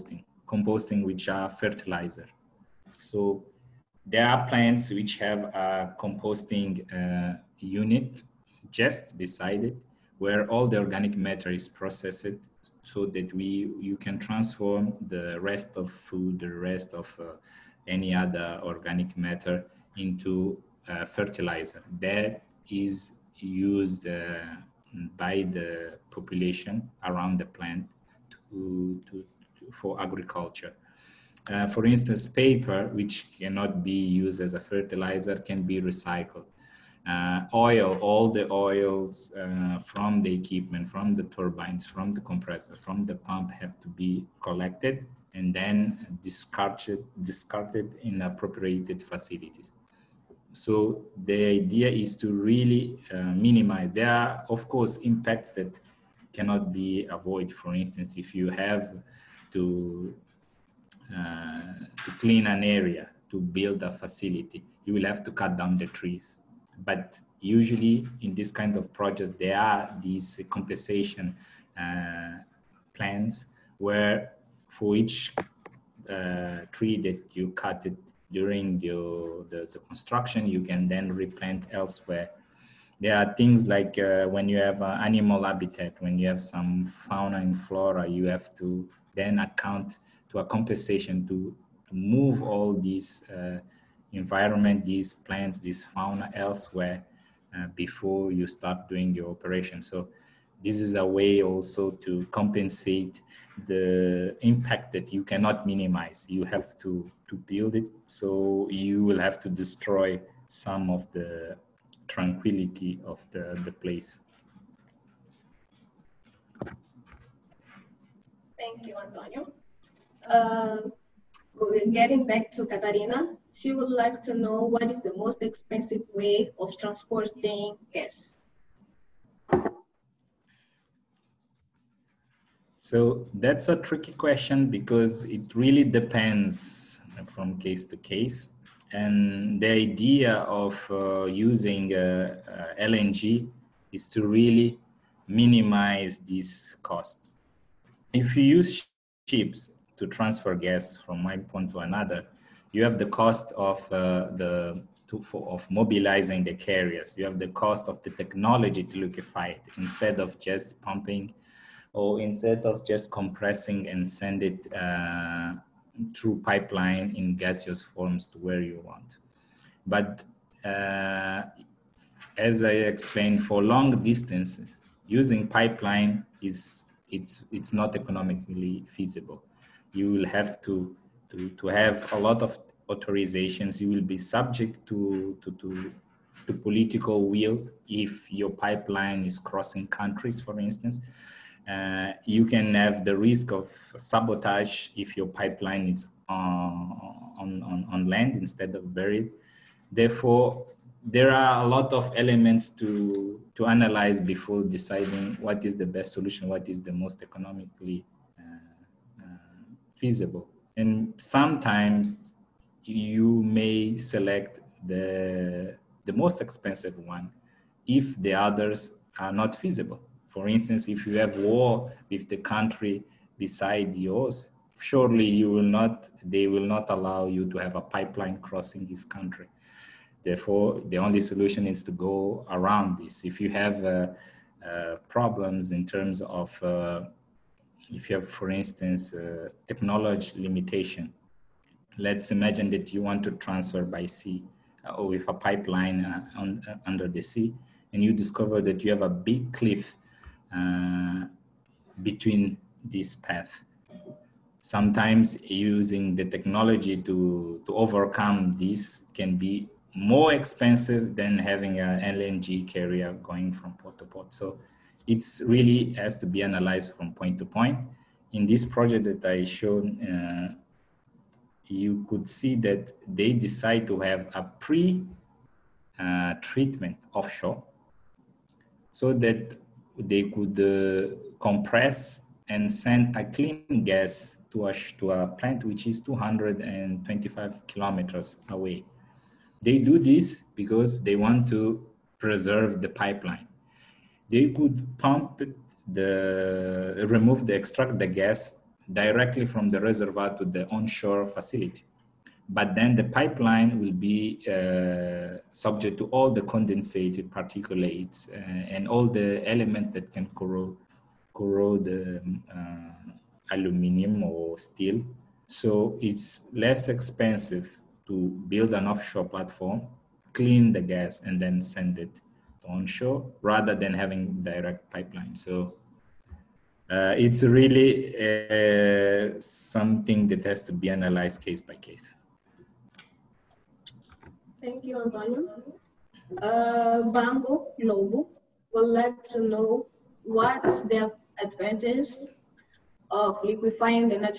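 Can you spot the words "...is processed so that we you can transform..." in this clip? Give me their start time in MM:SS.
00:11.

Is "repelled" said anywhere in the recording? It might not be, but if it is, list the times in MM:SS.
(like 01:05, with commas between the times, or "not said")
not said.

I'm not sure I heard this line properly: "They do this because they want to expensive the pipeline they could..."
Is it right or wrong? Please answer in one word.
wrong.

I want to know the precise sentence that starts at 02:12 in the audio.
So that's a tricky question because it really depends from case to case.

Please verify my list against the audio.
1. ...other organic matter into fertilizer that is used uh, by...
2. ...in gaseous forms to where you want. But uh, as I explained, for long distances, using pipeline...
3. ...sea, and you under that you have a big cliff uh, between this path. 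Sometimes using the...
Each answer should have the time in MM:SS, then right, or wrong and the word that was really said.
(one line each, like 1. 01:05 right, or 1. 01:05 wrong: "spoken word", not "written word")
1. 00:18 right
2. 02:47 right
3. 04:07 wrong: "discover", not "under".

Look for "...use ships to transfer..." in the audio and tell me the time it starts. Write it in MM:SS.
02:28.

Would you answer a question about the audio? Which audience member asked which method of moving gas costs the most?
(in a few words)
Katarina.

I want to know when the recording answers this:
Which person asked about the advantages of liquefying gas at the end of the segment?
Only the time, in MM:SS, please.
05:37.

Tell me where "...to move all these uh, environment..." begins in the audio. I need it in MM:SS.
01:31.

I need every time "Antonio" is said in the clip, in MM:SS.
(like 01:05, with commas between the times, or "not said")
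01:59, 05:35.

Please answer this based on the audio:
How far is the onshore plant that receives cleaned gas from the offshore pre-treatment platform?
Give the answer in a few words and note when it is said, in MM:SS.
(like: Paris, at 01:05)
225 kilometers, at 04:46.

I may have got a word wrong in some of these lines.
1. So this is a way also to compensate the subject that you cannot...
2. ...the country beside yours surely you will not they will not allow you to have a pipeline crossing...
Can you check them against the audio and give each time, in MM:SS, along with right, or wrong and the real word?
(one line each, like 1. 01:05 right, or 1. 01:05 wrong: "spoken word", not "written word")
1. 01:39 wrong: "impact", not "subject"
2. 03:42 right.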